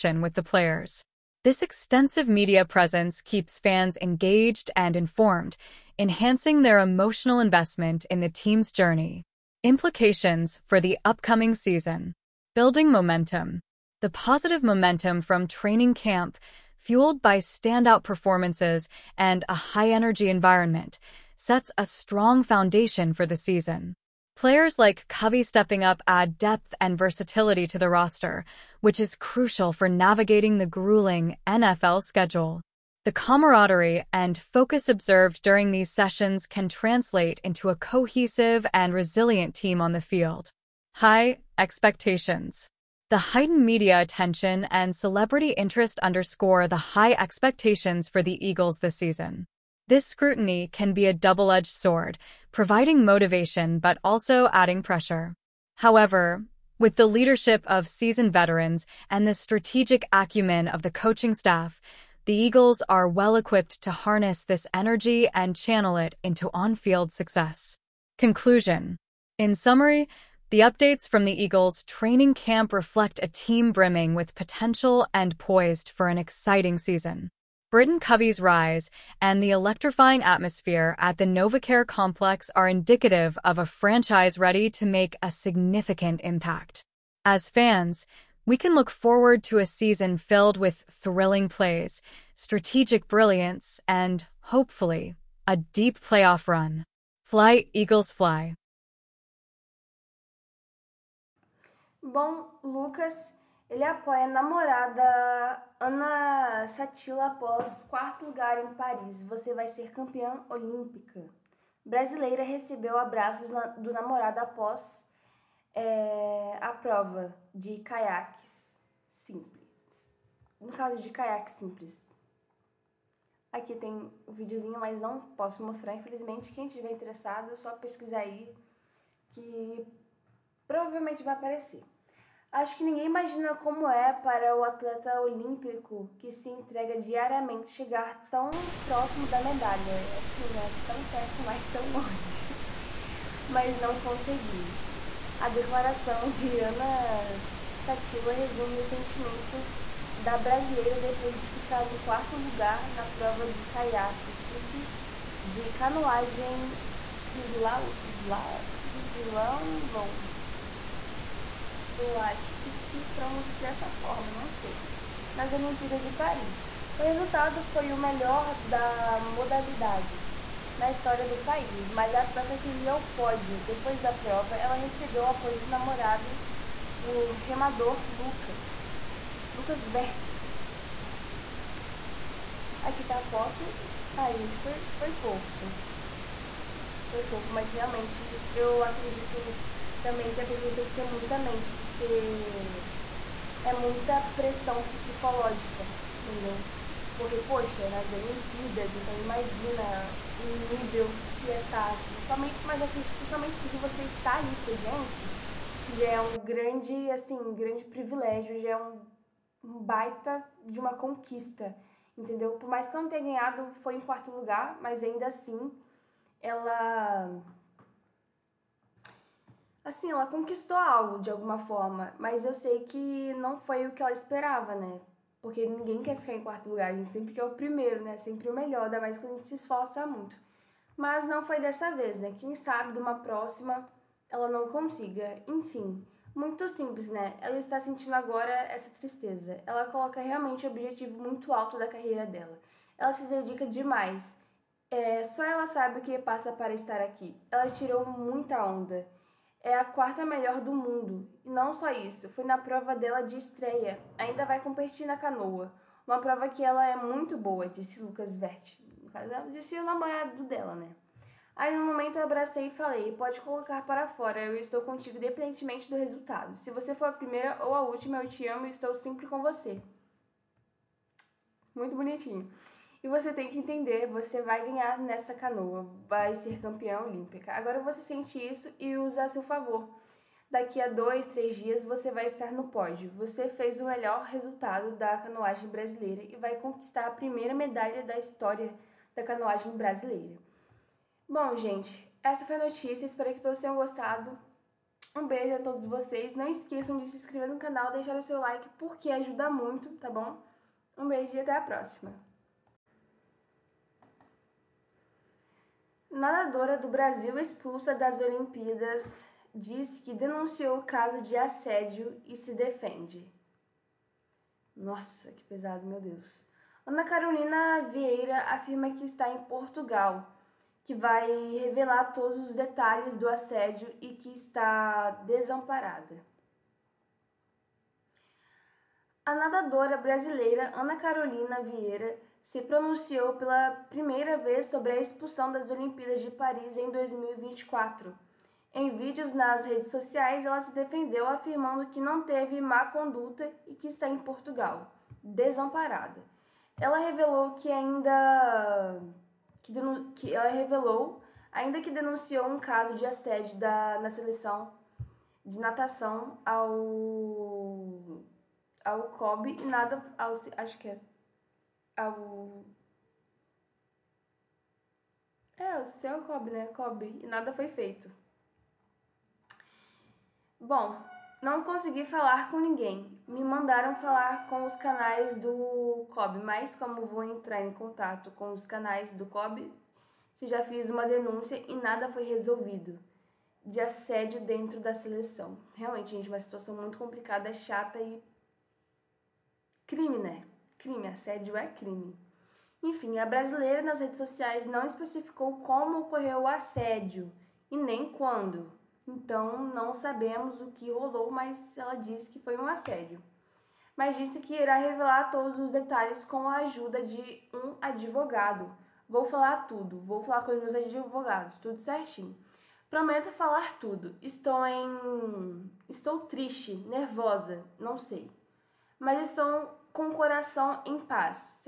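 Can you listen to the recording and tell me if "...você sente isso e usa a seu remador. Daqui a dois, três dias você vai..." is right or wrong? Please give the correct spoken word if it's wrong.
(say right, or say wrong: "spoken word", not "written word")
wrong: "favor", not "remador".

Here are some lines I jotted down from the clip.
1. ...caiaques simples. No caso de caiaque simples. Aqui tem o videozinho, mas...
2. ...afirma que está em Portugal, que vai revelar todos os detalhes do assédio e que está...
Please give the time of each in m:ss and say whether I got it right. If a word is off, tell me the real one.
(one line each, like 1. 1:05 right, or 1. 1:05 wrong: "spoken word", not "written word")
1. 1:57 right
2. 5:18 right.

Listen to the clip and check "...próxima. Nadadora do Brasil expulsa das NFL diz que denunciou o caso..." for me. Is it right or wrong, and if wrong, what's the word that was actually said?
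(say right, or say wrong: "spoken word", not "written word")
wrong: "Olimpíadas", not "NFL".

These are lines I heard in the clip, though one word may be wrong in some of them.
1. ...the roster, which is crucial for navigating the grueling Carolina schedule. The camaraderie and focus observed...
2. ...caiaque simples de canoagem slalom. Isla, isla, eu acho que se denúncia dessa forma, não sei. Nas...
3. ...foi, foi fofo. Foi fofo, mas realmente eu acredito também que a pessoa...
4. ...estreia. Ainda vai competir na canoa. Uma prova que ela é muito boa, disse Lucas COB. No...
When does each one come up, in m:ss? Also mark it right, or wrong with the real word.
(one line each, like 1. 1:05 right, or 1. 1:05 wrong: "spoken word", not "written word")
1. 0:27 wrong: "NFL", not "Carolina"
2. 2:33 wrong: "pronuncia", not "denúncia"
3. 3:04 right
4. 4:13 wrong: "Verti", not "COB".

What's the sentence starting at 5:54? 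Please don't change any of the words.
na seleção de natação ao ao COB e nada ao acho que é ao.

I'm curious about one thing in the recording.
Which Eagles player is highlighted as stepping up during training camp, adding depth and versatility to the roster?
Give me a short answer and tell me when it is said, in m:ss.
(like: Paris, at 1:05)
Britain Covey, at 1:17.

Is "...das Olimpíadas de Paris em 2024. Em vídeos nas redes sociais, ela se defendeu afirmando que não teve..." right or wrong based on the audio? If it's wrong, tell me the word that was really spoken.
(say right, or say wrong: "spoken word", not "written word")
right.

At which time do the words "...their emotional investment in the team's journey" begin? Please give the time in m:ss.
0:06.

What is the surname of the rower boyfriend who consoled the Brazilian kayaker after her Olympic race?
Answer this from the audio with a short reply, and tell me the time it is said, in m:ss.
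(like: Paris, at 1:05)
Vertin, at 2:59.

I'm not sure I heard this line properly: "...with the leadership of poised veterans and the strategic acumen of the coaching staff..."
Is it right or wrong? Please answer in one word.
wrong.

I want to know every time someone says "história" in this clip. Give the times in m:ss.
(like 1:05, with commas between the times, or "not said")
2:50, 4:48.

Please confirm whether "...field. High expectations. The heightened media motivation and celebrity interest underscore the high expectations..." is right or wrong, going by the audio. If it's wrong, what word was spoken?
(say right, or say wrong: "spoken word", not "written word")
wrong: "attention", not "motivation".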